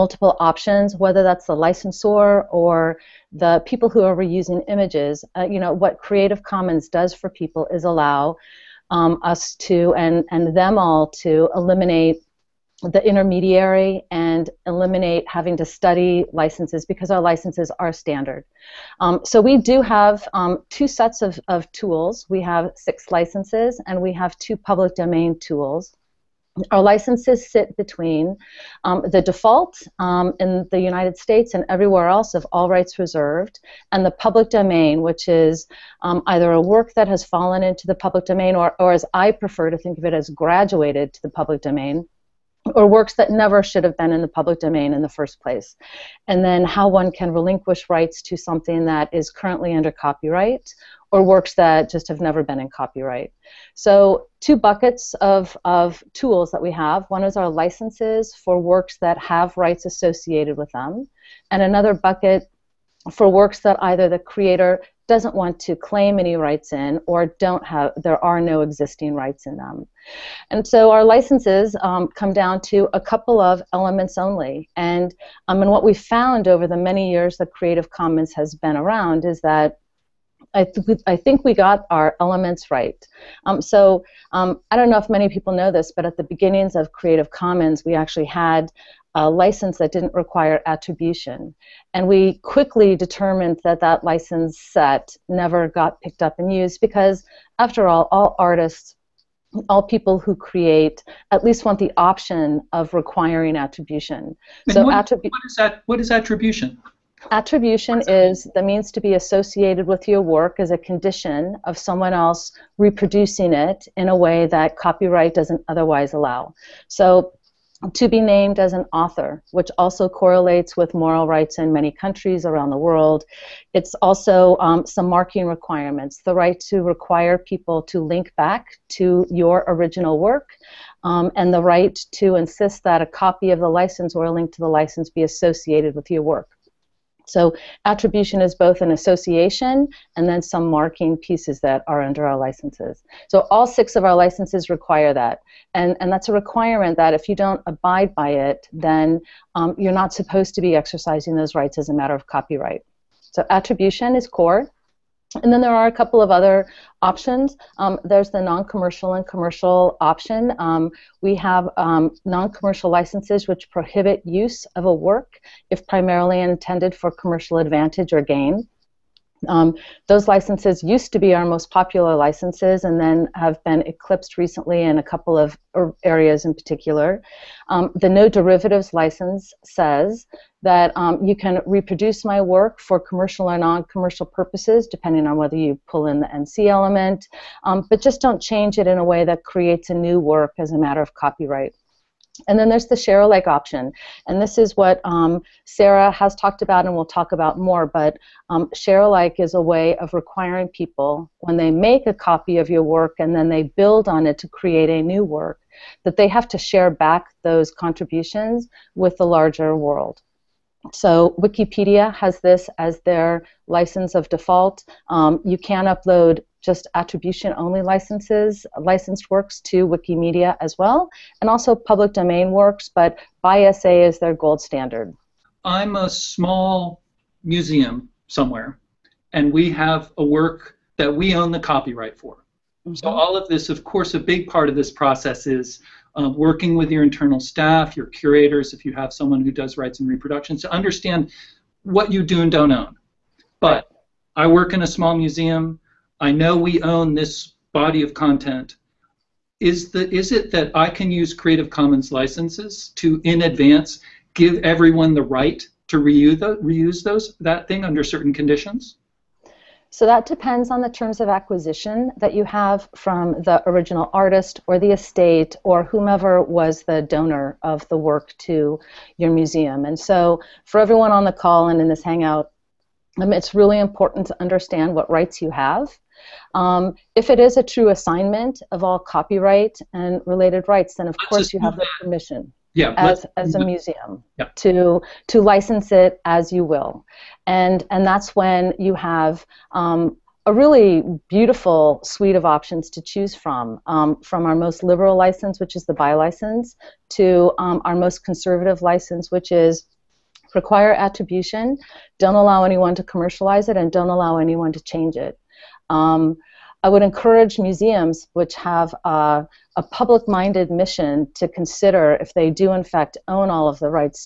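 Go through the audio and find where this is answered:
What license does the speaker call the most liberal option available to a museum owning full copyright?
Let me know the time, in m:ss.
4:55.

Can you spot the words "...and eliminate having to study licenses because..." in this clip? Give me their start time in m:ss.
0:14.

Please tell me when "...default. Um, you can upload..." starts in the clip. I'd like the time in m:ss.
3:34.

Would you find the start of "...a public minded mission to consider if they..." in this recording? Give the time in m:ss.
5:09.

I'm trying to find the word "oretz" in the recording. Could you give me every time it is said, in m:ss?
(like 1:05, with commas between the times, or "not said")
not said.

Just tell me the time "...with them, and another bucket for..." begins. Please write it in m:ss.
1:00.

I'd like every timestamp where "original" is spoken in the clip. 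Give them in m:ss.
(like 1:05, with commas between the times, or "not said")
2:09, 4:23.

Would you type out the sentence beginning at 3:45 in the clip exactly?
I'm a small museum somewhere, and we have a work that we own the copyright for.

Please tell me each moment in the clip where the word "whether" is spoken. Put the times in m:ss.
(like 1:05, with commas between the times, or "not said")
0:00, 3:05.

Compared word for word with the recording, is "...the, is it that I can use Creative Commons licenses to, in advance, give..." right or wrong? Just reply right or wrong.
right.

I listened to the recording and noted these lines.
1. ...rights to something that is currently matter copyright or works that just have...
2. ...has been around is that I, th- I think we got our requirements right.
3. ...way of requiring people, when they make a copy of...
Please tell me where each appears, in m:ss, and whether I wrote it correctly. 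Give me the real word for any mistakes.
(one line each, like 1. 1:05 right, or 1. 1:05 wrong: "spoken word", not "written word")
1. 0:47 wrong: "under", not "matter"
2. 1:18 wrong: "elements", not "requirements"
3. 3:19 right.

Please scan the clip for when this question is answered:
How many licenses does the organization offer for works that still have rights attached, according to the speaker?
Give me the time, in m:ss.
0:22.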